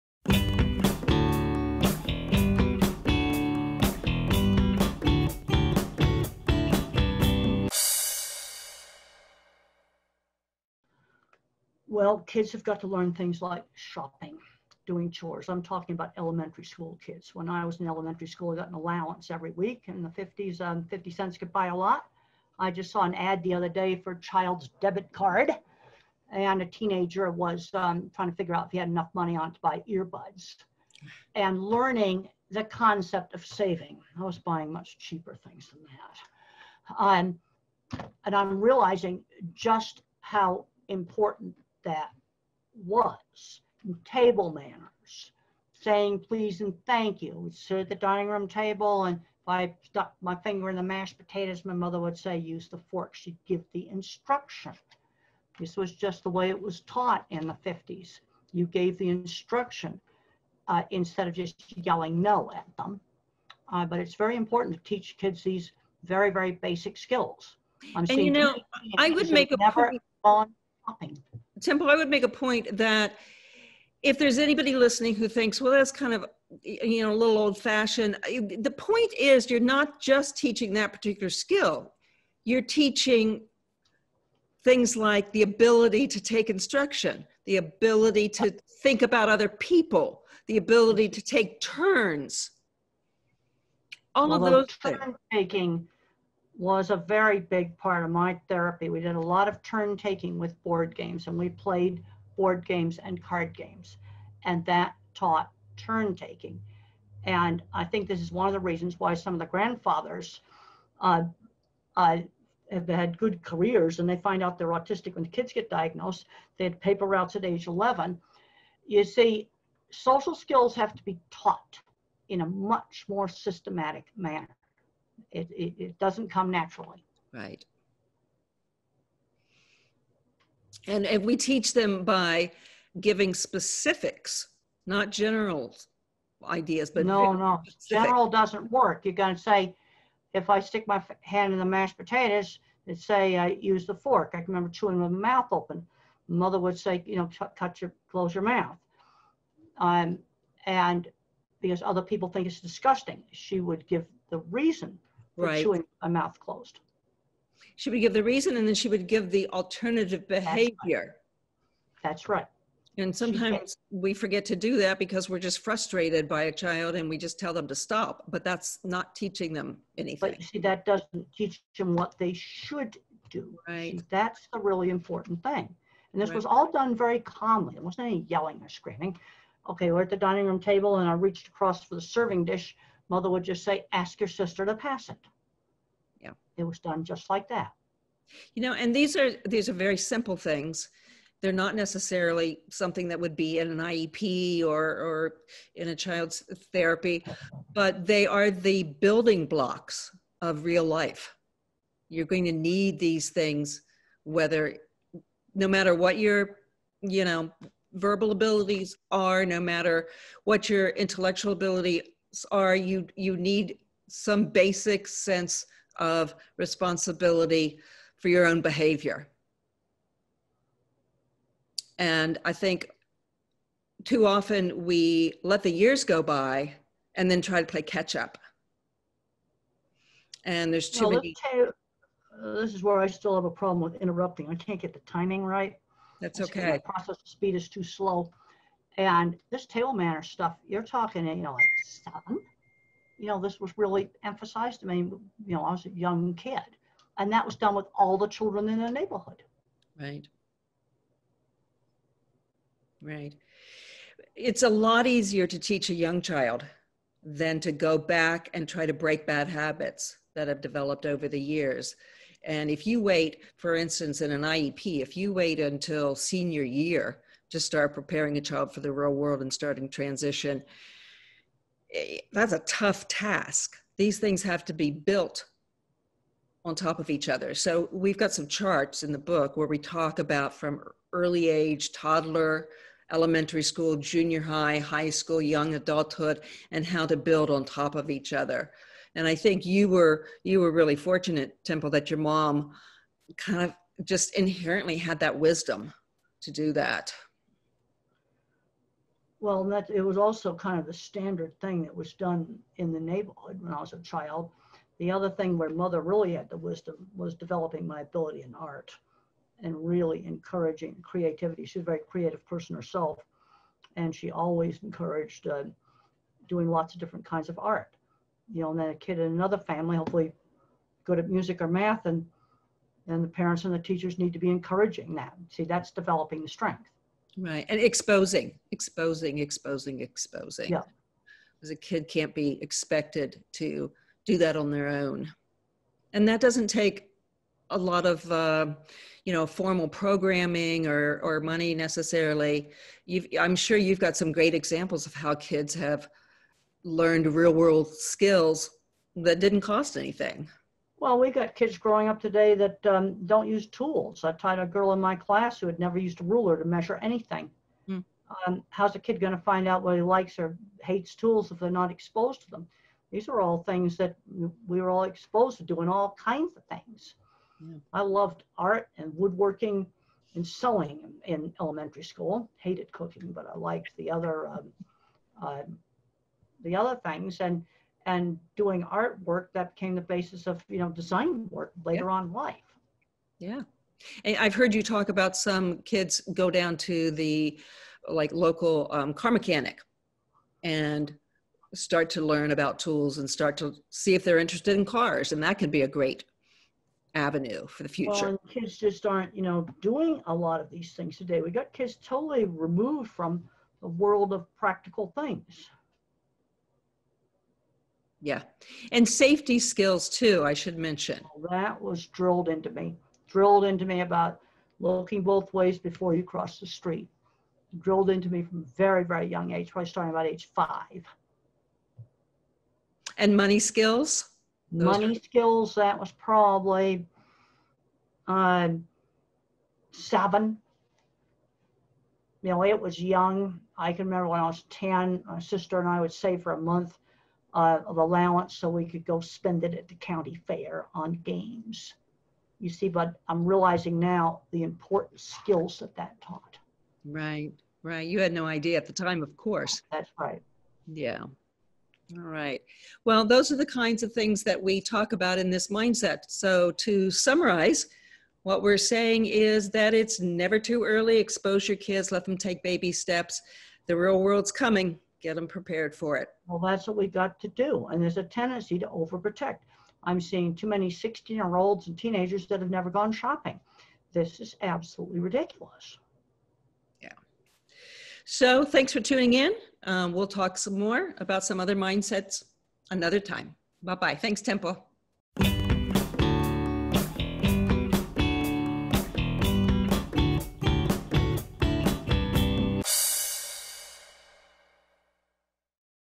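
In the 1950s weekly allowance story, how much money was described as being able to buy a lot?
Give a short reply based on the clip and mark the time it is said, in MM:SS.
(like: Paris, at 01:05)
50 cents, at 00:20.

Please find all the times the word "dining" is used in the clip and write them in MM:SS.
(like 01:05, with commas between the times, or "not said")
00:47, 03:00.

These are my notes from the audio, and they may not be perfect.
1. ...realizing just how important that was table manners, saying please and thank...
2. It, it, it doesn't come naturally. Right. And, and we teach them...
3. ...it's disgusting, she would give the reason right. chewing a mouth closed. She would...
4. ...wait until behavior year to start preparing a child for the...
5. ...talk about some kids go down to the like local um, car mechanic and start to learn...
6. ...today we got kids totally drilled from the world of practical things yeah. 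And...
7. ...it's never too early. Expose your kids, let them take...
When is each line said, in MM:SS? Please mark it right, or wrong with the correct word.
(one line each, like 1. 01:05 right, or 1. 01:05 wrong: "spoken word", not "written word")
1. 00:38 right
2. 02:05 right
3. 02:32 right
4. 04:25 wrong: "senior", not "behavior"
5. 06:24 right
6. 06:41 wrong: "removed", not "drilled"
7. 07:39 right.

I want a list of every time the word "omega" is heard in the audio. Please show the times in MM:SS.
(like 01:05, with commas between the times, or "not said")
not said.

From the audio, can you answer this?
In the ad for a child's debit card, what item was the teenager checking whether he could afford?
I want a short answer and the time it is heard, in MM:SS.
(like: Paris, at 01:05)
Earbuds, at 00:29.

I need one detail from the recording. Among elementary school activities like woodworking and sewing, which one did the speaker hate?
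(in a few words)
Cooking.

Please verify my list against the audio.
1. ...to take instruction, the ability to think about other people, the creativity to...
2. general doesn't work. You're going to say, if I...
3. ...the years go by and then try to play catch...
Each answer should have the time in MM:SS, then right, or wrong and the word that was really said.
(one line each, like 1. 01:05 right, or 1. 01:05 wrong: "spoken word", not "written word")
1. 01:26 wrong: "ability", not "creativity"
2. 02:18 right
3. 03:45 right.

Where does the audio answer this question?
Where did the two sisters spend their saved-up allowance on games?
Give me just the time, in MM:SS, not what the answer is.
07:19.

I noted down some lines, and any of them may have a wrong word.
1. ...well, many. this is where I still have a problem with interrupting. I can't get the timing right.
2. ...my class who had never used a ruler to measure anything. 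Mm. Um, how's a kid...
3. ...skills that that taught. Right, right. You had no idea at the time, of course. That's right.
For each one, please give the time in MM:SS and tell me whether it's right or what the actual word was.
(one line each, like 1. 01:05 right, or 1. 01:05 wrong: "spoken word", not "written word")
1. 03:51 right
2. 05:55 right
3. 07:25 right.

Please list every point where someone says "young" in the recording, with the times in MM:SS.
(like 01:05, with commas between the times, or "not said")
04:05, 04:15, 04:45, 06:59, 07:13.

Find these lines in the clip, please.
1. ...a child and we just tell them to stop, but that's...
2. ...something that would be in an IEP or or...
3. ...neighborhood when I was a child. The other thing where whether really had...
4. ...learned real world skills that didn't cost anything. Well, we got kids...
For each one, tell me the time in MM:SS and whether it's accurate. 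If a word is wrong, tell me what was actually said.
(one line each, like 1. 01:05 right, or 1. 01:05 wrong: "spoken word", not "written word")
1. 02:46 right
2. 03:12 right
3. 05:02 wrong: "mother", not "whether"
4. 05:46 right.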